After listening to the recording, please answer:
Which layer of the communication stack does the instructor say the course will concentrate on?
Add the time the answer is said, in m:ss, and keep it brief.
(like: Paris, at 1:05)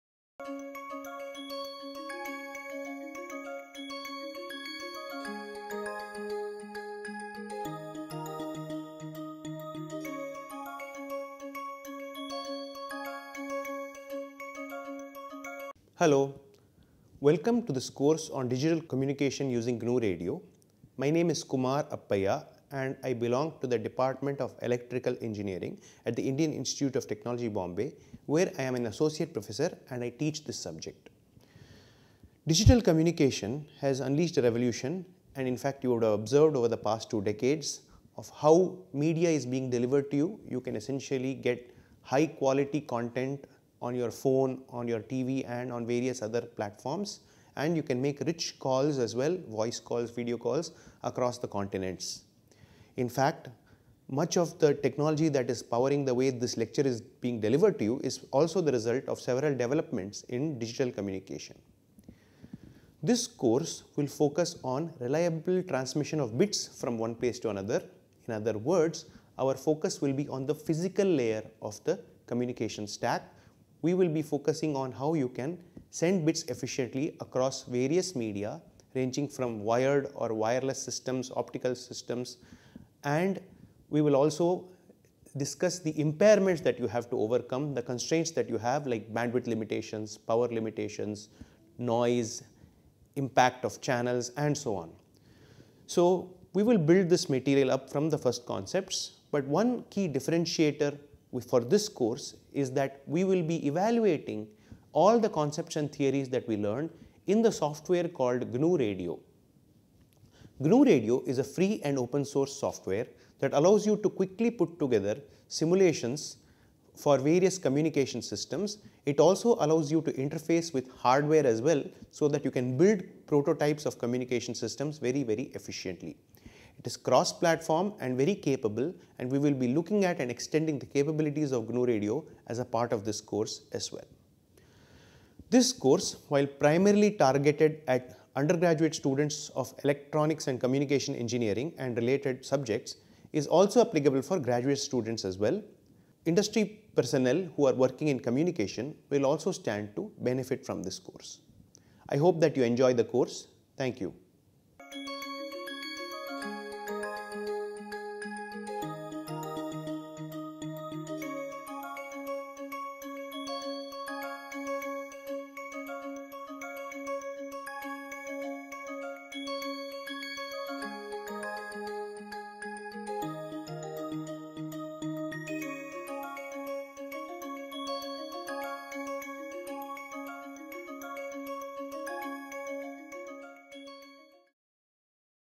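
Physical layer, at 1:10.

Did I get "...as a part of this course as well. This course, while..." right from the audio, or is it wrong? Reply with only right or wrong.
right.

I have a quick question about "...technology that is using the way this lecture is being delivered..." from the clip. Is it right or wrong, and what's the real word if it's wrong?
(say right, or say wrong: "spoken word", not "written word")
wrong: "powering", not "using".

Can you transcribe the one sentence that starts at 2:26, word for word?
Industry personnel who are working in communication will also stand to benefit from this course.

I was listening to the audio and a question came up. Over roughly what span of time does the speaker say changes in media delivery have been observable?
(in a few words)
Two decades.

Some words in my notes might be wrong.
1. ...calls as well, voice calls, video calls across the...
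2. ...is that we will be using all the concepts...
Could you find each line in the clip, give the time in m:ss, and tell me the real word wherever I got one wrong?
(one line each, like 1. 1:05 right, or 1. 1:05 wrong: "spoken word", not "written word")
1. 0:48 right
2. 1:42 wrong: "evaluating", not "using".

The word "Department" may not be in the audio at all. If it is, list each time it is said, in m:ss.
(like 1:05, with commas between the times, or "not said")
0:23.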